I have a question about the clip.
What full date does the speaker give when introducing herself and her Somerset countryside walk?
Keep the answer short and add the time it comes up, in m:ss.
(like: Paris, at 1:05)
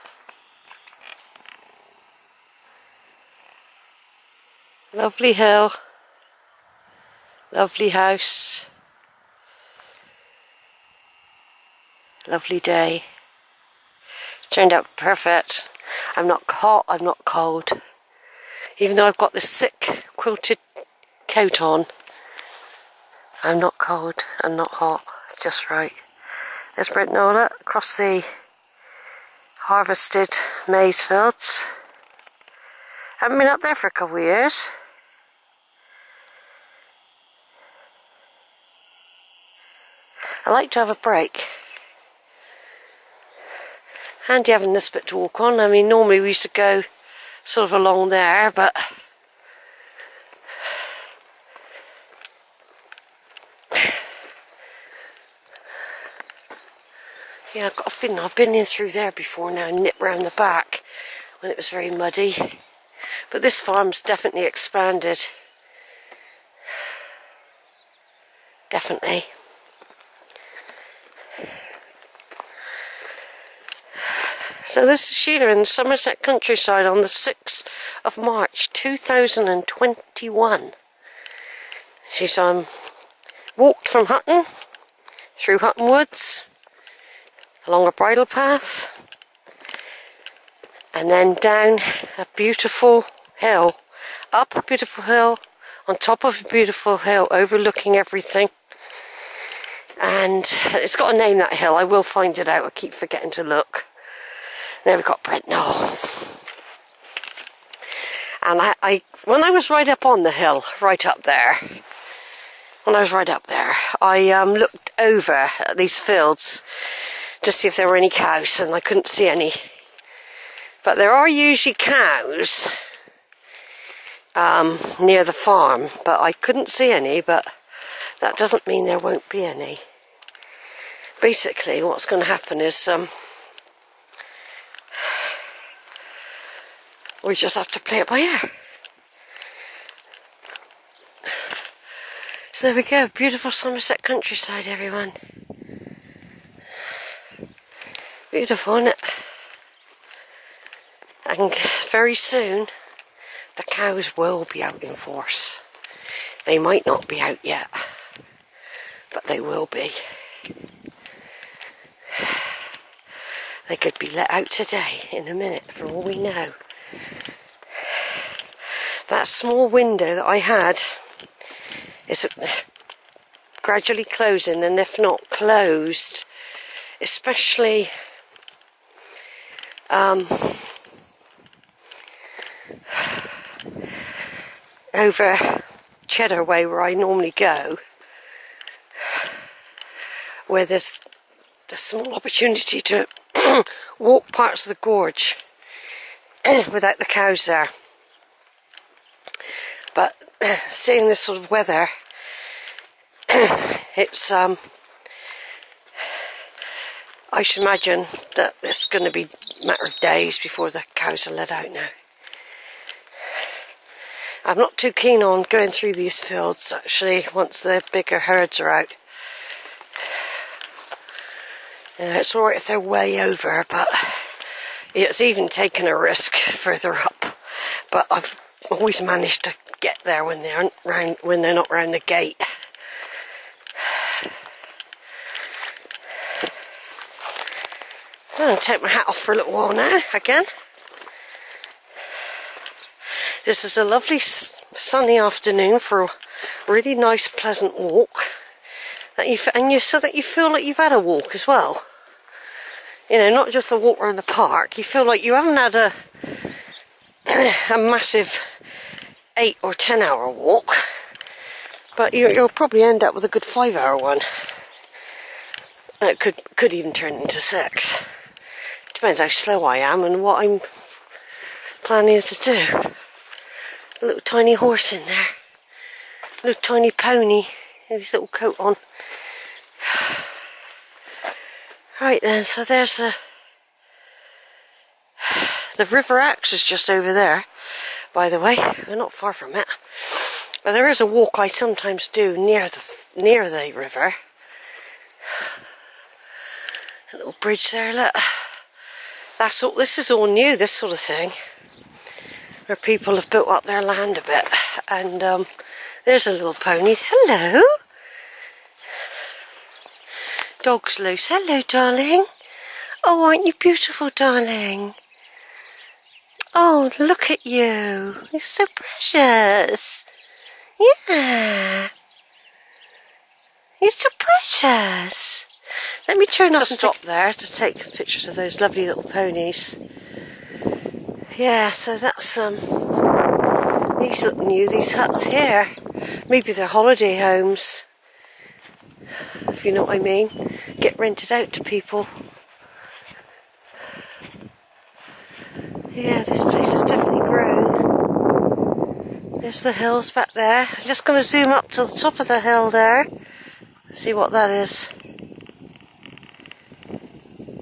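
6 March 2021, at 1:17.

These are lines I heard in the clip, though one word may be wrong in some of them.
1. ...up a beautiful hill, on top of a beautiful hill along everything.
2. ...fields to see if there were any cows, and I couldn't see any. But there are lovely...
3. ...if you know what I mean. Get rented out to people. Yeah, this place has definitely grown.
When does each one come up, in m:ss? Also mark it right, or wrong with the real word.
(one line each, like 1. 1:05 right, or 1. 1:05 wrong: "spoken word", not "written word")
1. 1:34 wrong: "overlooking", not "along"
2. 1:55 wrong: "usually", not "lovely"
3. 5:39 right.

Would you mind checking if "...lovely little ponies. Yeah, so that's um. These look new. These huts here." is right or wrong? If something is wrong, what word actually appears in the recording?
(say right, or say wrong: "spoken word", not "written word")
right.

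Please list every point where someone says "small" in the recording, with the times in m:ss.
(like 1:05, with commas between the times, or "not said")
2:49, 3:11.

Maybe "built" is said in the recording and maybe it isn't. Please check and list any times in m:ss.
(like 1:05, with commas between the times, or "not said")
5:03.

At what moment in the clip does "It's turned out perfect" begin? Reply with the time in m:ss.
0:14.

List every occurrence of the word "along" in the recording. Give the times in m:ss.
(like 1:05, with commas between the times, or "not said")
0:47, 1:27.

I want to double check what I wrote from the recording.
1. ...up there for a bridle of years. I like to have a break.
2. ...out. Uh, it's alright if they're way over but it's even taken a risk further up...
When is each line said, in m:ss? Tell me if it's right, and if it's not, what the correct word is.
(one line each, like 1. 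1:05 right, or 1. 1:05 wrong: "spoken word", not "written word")
1. 0:33 wrong: "couple", not "bridle"
2. 3:38 right.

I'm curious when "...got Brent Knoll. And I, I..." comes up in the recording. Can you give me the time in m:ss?
1:45.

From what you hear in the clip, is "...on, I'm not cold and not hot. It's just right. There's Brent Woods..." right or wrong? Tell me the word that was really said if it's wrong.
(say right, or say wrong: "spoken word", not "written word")
wrong: "Knoll", not "Woods".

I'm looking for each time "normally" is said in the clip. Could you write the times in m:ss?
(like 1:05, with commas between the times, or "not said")
0:45, 3:06.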